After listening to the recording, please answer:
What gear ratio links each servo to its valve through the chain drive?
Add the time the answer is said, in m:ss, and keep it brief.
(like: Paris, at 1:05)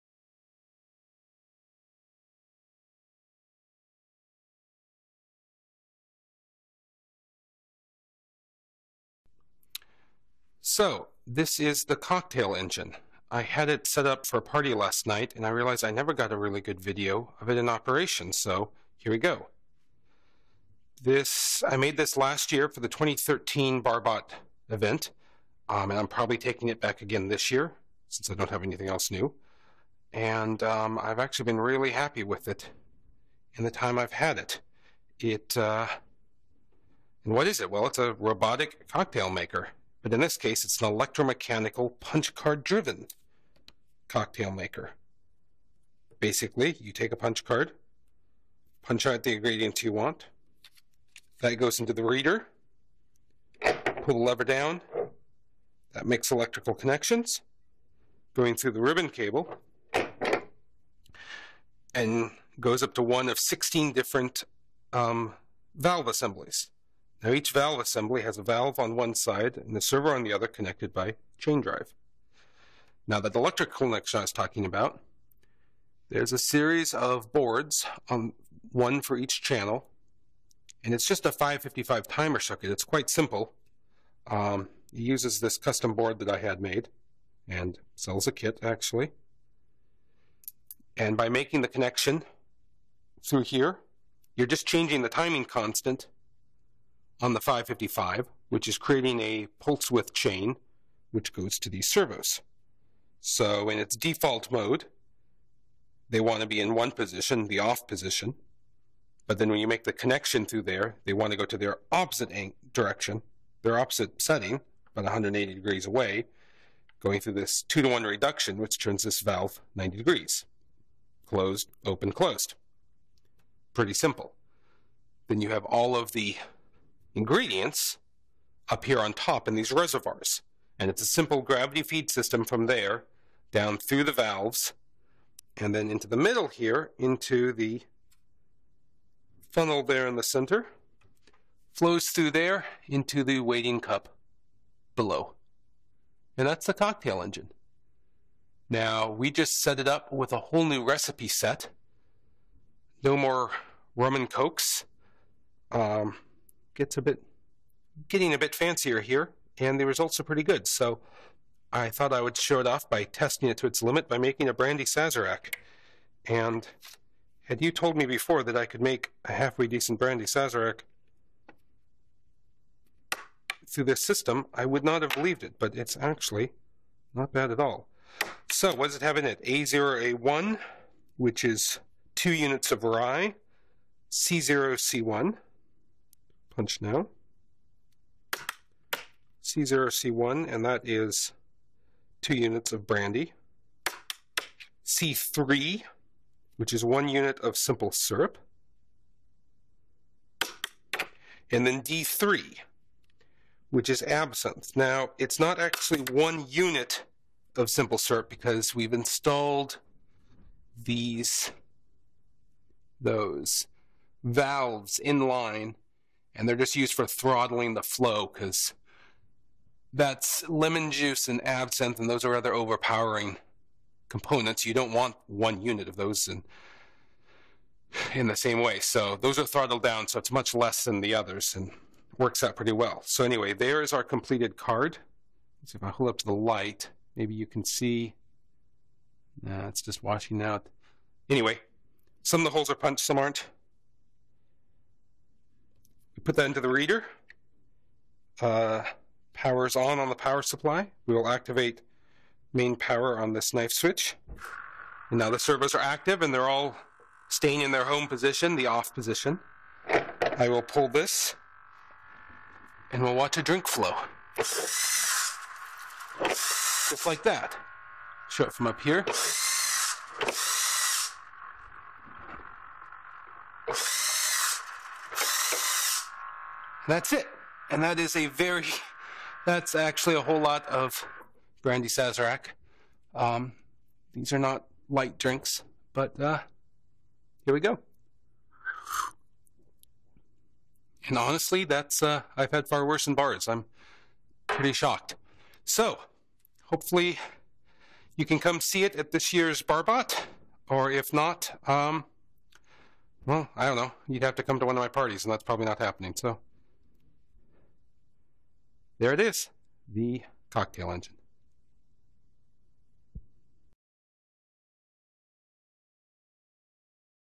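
2 to 1, at 1:57.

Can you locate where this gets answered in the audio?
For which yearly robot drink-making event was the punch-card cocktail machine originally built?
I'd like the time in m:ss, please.
0:22.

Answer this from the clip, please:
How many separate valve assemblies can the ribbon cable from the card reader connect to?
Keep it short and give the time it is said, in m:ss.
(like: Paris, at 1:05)
16, at 1:03.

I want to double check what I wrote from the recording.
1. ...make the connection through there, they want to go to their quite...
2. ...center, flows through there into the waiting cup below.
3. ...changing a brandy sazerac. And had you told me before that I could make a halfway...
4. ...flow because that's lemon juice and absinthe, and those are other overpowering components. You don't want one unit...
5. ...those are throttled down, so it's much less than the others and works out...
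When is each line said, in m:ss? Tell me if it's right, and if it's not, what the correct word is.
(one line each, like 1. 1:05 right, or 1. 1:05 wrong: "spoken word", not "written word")
1. 1:49 wrong: "opposite", not "quite"
2. 2:20 right
3. 2:44 wrong: "making", not "changing"
4. 3:37 right
5. 3:49 right.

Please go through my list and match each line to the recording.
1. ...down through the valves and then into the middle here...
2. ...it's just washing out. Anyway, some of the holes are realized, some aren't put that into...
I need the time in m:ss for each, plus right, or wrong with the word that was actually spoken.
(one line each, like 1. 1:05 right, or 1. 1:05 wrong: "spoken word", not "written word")
1. 2:13 right
2. 3:59 wrong: "punched", not "realized".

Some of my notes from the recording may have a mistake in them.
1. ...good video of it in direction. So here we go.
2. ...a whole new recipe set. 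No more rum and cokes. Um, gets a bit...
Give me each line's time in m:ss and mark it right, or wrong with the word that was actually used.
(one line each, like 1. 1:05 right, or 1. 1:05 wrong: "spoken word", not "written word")
1. 0:16 wrong: "operation", not "direction"
2. 2:30 right.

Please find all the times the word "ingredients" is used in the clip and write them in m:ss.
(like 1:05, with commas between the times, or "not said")
0:49, 2:07.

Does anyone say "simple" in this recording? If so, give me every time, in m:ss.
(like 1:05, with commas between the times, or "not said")
1:23, 2:03, 2:11, 3:17, 3:27.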